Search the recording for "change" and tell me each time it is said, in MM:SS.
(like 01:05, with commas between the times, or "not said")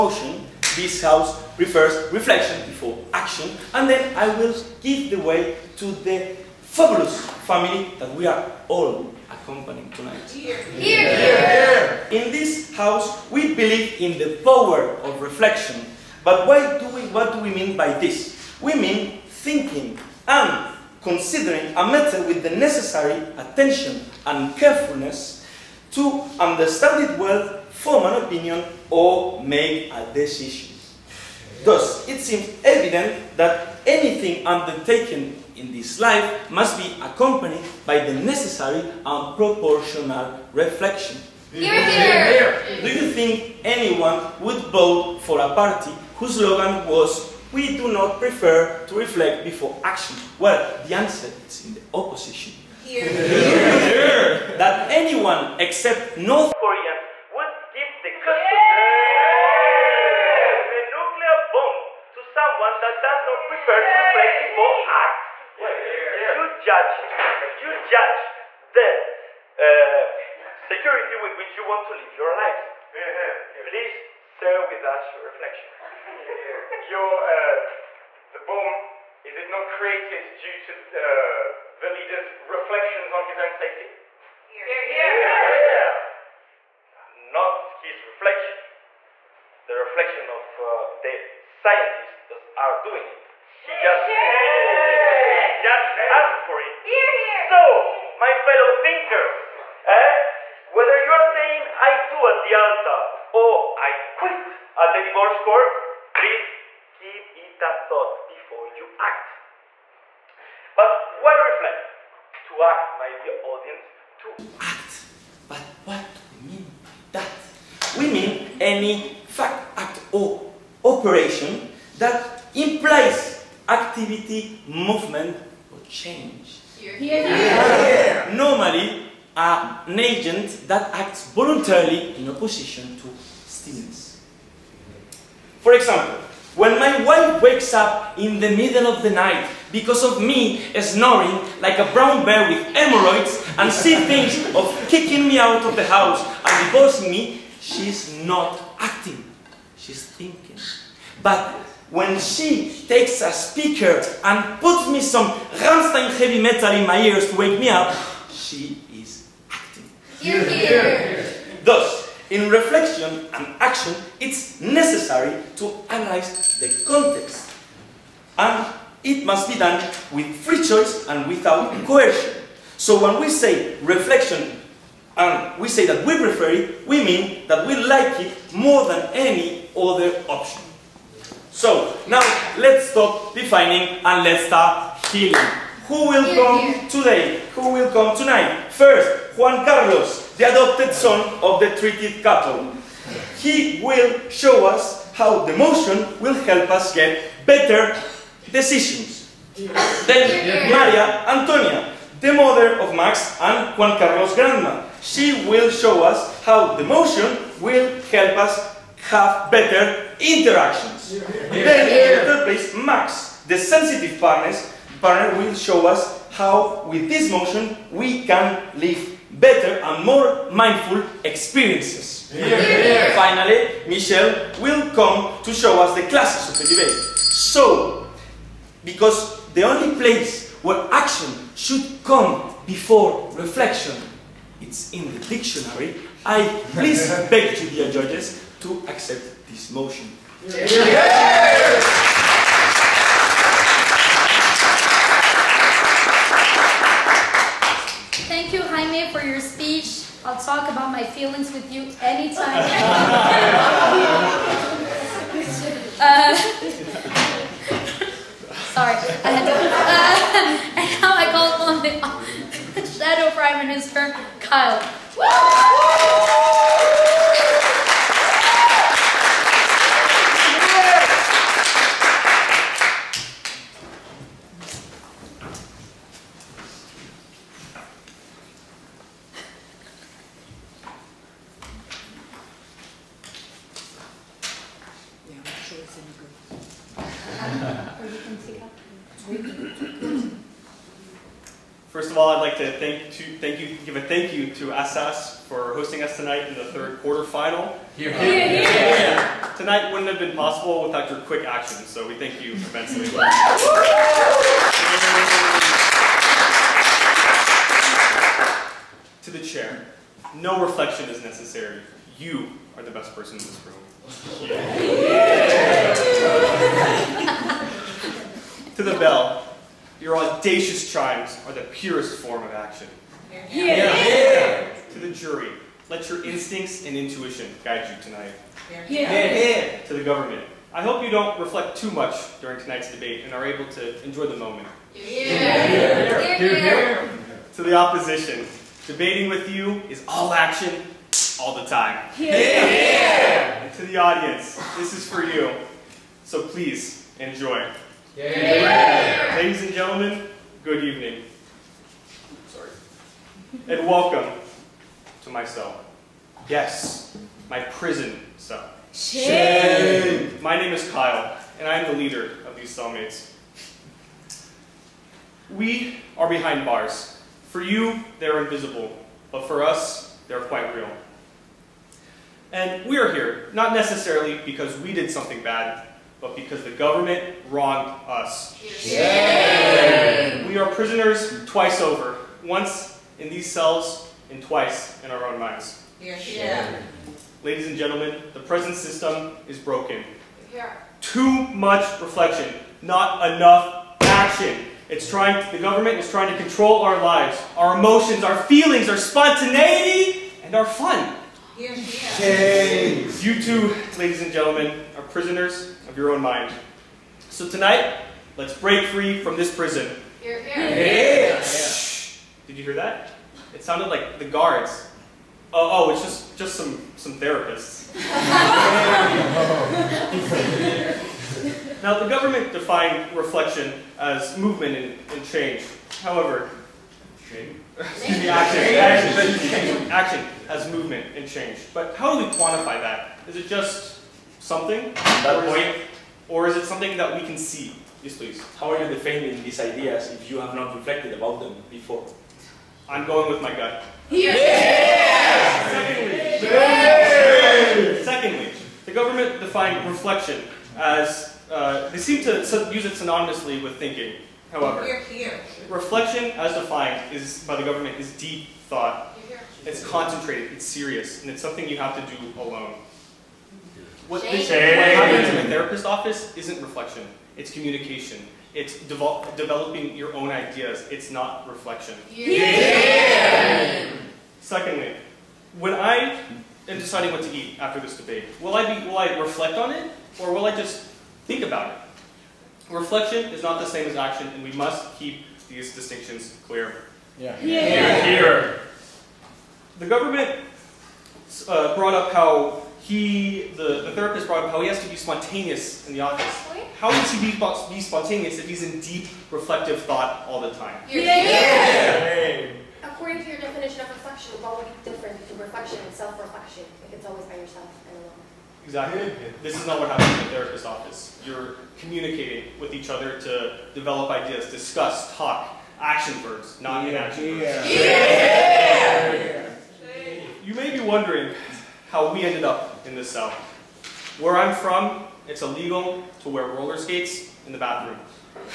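02:05, 07:05, 07:11.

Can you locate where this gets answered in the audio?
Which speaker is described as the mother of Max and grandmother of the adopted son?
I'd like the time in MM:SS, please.
03:20.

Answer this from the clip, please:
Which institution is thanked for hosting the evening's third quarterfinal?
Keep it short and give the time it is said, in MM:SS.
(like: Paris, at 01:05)
Assas, at 04:54.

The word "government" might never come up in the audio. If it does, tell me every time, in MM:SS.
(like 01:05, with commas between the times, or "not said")
05:30, 06:16, 06:35, 07:02, 07:28, 07:37, 08:09.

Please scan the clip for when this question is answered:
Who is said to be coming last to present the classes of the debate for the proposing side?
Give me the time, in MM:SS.
03:43.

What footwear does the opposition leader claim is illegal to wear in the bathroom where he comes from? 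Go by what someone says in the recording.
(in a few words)
roller skates.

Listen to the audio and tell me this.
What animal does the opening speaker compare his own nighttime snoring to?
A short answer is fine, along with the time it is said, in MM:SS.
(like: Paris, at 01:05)
brown bear, at 02:21.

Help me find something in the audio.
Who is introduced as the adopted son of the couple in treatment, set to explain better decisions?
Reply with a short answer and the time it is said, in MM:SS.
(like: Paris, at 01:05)
Juan Carlos, at 03:09.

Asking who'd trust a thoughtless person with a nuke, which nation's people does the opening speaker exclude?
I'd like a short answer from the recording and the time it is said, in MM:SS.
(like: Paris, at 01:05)
North Koreans, at 00:56.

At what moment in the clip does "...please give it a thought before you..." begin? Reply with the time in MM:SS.
01:46.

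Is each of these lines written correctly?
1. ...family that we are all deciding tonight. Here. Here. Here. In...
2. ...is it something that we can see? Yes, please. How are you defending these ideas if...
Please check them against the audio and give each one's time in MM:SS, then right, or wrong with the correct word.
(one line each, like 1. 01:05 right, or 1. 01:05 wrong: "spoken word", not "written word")
1. 00:07 wrong: "accompanying", not "deciding"
2. 07:16 right.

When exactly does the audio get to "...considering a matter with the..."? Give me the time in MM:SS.
00:21.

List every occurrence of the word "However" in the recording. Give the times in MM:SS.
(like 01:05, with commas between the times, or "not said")
07:06, 07:34.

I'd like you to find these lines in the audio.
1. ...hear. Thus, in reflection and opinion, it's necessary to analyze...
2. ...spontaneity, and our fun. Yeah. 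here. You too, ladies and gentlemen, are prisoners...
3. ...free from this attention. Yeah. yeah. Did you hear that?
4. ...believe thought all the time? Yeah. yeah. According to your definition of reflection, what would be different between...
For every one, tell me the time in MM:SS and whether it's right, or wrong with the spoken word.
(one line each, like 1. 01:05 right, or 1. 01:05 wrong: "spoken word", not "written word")
1. 02:40 wrong: "action", not "opinion"
2. 06:38 right
3. 06:48 wrong: "prison", not "attention"
4. 08:19 wrong: "reflective", not "believe".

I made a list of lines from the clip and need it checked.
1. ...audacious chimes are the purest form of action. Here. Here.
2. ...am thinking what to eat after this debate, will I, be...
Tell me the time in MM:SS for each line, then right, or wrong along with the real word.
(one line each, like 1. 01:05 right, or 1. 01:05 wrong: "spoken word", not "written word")
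1. 05:20 right
2. 07:56 wrong: "deciding", not "thinking".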